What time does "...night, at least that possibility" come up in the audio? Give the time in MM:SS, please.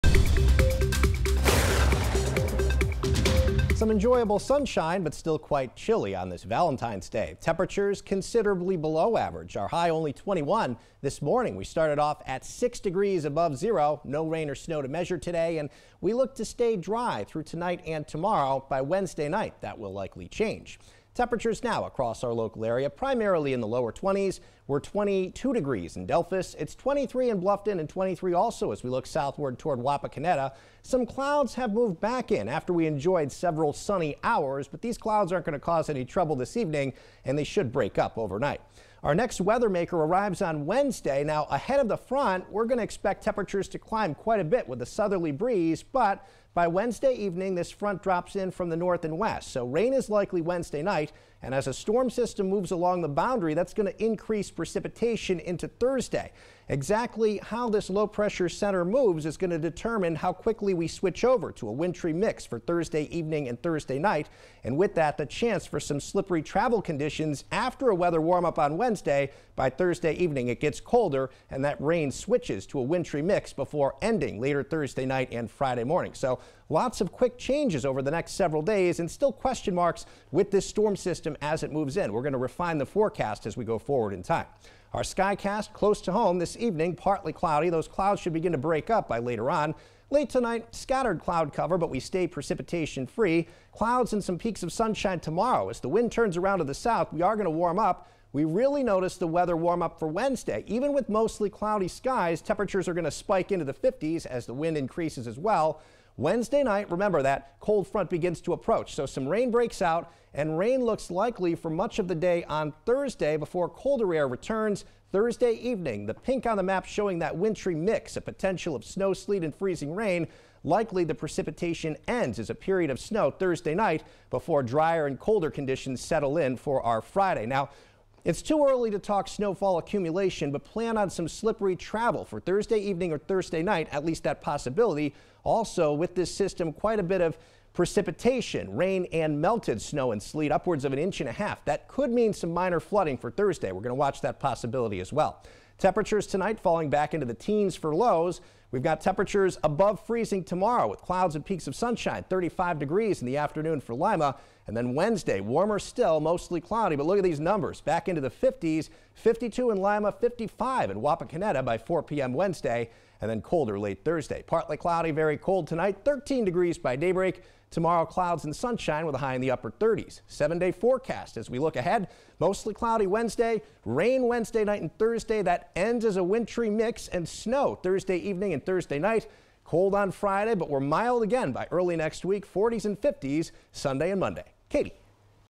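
02:13.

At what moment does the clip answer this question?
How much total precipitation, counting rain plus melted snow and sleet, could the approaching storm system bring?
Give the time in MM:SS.
02:20.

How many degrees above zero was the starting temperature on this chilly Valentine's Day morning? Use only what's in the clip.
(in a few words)
6.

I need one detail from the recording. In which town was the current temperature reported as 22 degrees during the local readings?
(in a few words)
Delphos.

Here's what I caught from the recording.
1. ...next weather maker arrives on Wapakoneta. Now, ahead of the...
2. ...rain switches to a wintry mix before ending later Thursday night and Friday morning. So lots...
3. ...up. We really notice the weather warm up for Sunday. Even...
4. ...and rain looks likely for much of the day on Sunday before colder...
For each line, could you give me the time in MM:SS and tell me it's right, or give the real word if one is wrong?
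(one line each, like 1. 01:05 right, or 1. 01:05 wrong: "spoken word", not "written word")
1. 00:39 wrong: "Wednesday", not "Wapakoneta"
2. 01:11 right
3. 01:37 wrong: "Wednesday", not "Sunday"
4. 01:50 wrong: "Thursday", not "Sunday".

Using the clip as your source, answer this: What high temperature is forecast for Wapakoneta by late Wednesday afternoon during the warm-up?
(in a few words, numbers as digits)
55.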